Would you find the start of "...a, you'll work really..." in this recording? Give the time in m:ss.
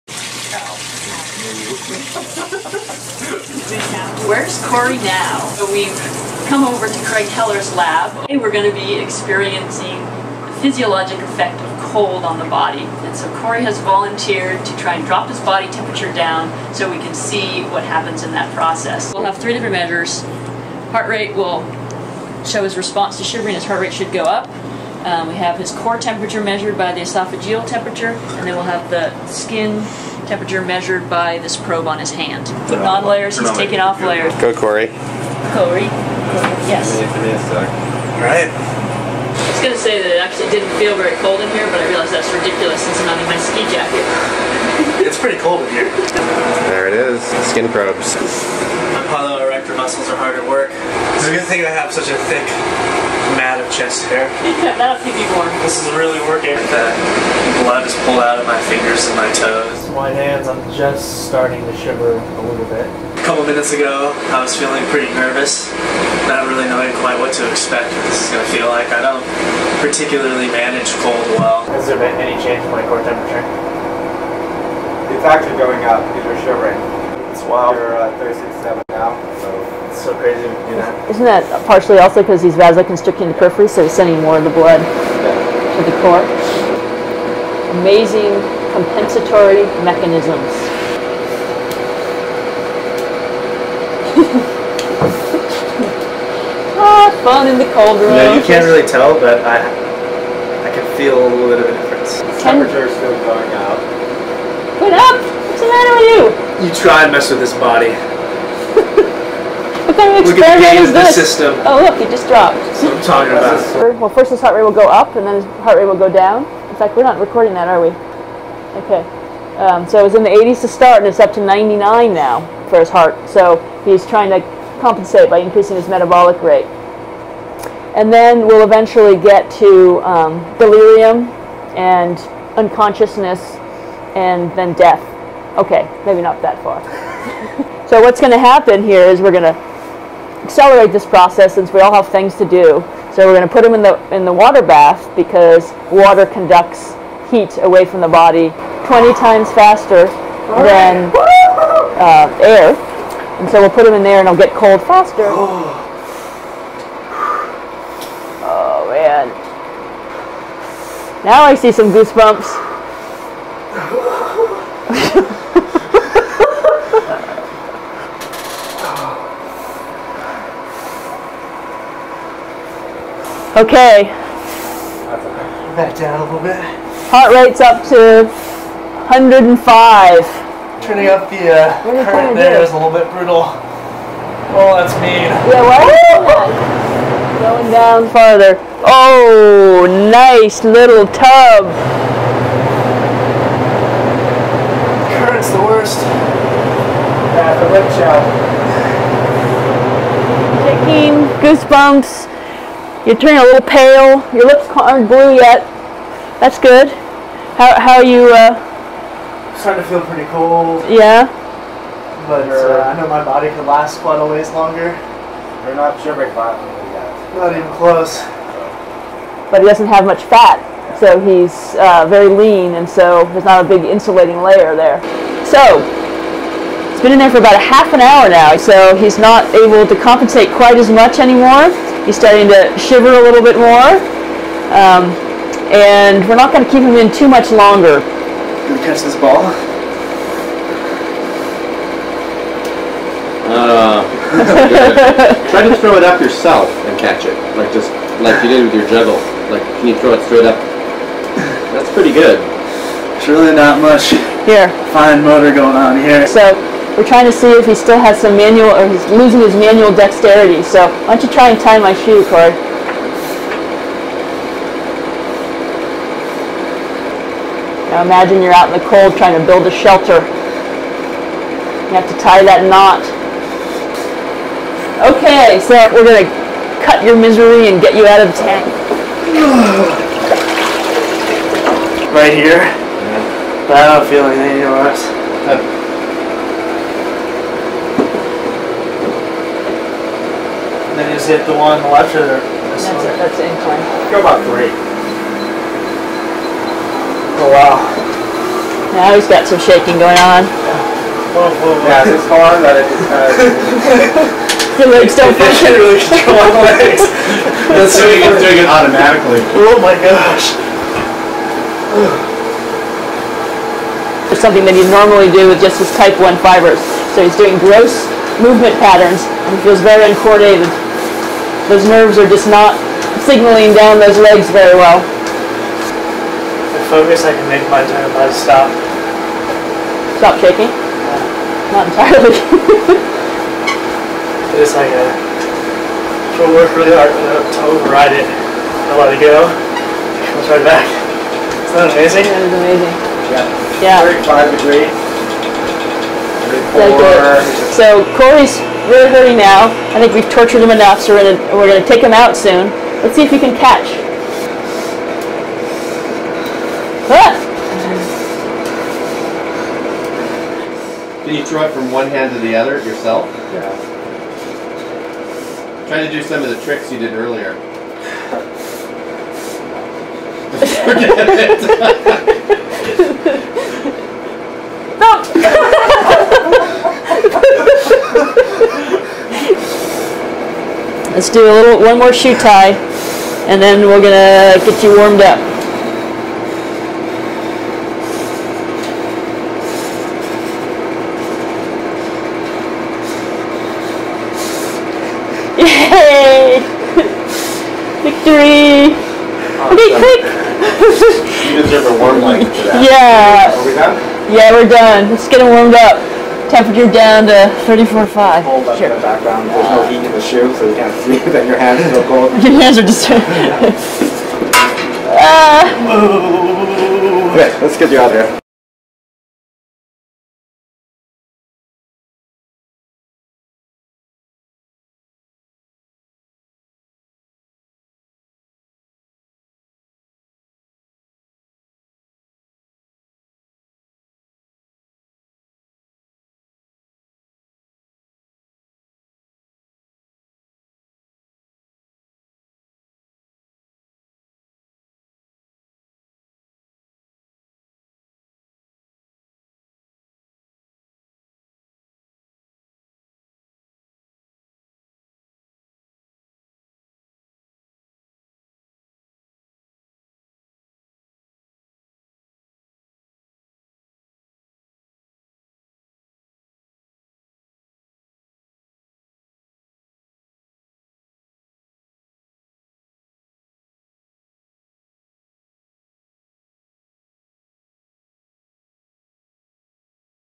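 5:34.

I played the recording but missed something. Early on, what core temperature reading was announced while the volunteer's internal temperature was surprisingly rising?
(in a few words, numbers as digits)
36.7.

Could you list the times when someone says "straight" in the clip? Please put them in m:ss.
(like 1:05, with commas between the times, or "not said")
4:10.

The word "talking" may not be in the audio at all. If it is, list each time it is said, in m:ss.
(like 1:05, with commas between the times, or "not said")
1:53.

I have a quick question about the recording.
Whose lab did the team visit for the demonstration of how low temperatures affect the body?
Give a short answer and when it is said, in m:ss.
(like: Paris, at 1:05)
Craig Heller, at 0:07.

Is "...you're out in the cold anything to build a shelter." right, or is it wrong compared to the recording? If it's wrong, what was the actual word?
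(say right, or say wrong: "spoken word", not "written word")
wrong: "trying", not "anything".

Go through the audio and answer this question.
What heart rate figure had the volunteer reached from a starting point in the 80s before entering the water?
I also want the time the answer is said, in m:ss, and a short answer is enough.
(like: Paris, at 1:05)
99, at 2:01.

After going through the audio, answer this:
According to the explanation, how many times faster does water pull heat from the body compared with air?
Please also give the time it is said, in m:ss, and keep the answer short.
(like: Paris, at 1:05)
20, at 2:28.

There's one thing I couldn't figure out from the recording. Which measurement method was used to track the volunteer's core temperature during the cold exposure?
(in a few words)
esophageal temperature.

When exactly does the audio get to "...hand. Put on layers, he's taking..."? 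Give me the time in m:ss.
0:32.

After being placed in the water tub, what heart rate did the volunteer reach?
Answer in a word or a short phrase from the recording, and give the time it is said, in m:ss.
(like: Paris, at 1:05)
105, at 2:59.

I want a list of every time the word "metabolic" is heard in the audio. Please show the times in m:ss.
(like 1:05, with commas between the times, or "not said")
2:05.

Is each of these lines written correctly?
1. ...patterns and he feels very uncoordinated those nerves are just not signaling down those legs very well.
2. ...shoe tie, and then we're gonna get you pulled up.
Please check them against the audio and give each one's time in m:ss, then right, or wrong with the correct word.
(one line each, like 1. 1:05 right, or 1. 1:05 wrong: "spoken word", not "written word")
1. 5:18 right
2. 6:22 wrong: "warmed", not "pulled".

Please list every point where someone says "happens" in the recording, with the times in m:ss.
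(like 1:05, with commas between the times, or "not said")
0:17, 2:18.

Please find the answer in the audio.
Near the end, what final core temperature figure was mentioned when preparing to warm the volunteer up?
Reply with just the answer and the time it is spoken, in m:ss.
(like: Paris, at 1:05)
34.5, at 6:47.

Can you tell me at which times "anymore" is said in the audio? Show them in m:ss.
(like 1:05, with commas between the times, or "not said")
3:51, 4:44.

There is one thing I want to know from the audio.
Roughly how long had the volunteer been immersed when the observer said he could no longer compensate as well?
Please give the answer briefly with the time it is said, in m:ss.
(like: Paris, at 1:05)
half an hour, at 3:47.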